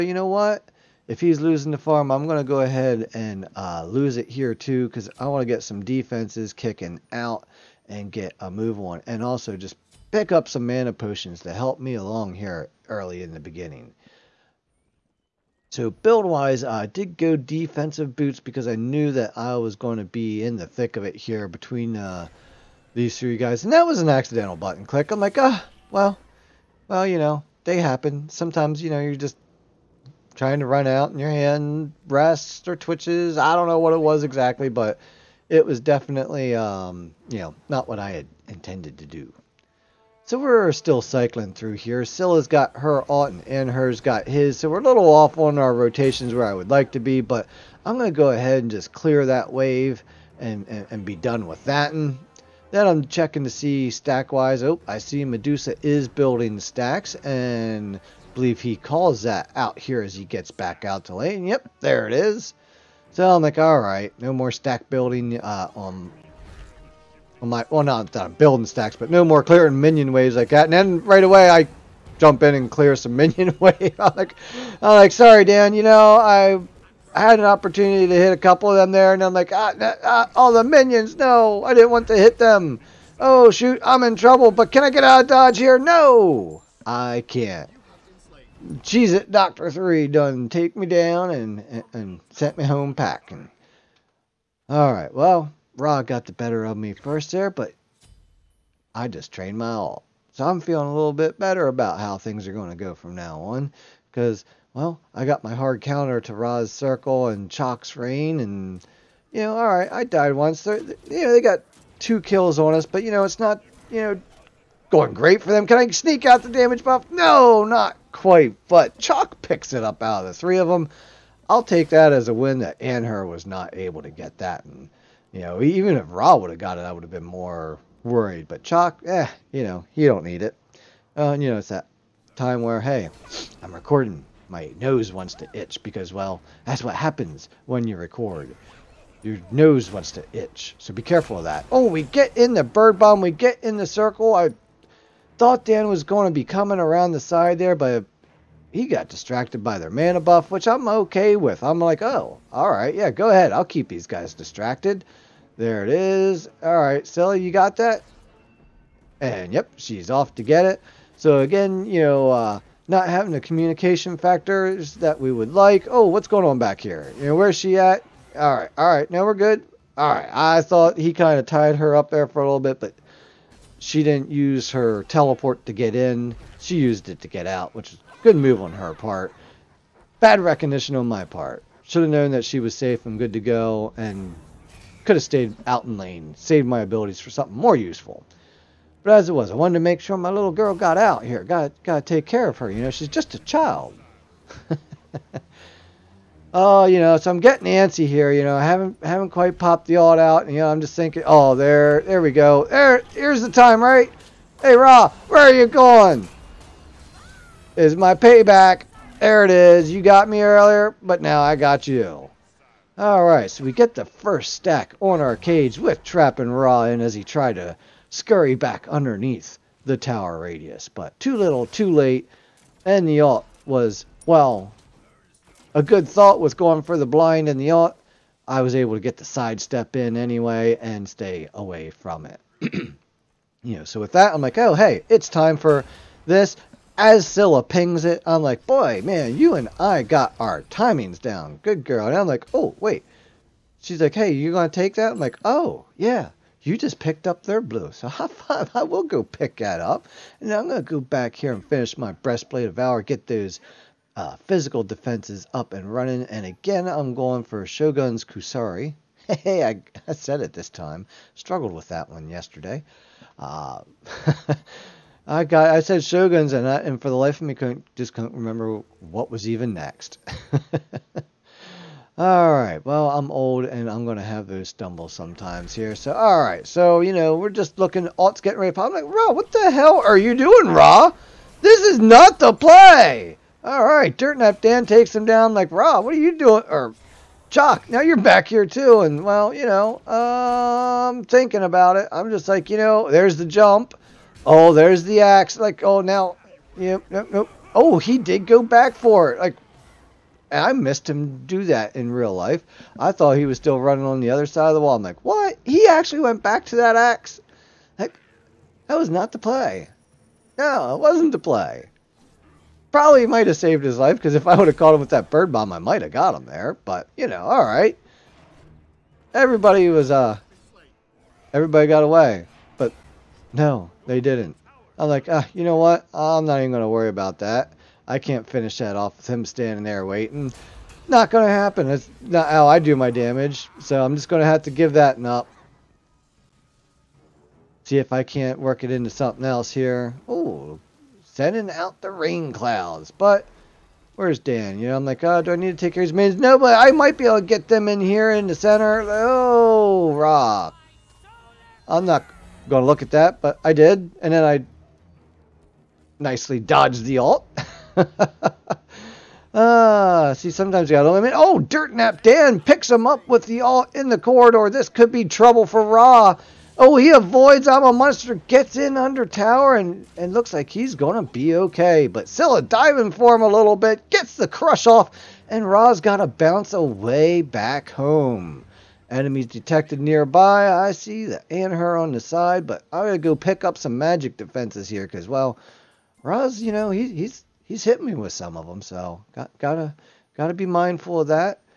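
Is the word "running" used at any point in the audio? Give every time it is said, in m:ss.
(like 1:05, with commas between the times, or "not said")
4:15, 5:03.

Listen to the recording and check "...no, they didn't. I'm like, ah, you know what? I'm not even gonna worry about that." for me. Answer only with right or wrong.
right.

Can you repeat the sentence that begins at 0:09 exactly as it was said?
And also just pick up some mana potions to help me along here early in the beginning.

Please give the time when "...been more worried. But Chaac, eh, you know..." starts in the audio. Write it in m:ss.
2:07.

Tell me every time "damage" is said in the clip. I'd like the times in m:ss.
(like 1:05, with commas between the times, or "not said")
1:56, 5:33.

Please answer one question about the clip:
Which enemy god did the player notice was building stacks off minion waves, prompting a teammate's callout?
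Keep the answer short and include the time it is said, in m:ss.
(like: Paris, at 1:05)
Medusa, at 0:55.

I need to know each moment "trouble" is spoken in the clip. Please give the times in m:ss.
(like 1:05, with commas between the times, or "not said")
1:24, 6:05.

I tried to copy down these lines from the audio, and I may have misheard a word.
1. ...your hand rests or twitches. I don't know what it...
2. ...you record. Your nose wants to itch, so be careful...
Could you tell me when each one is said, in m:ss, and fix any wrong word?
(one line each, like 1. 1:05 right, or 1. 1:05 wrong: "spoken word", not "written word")
1. 0:31 right
2. 2:17 right.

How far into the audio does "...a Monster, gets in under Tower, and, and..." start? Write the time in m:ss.
6:07.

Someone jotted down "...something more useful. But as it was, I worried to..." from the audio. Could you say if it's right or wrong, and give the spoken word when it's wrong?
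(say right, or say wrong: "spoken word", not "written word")
wrong: "wanted", not "worried".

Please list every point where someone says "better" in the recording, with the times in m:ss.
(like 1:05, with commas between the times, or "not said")
1:36, 1:41.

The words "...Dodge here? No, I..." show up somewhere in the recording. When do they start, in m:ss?
1:25.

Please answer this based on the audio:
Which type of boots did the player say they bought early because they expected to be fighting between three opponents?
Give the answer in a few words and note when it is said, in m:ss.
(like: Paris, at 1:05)
Defensive boots, at 0:17.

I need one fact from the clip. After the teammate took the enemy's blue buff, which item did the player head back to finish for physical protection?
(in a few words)
Breastplate of Valor.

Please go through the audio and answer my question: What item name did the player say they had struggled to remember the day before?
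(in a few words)
Shogun's Kusari.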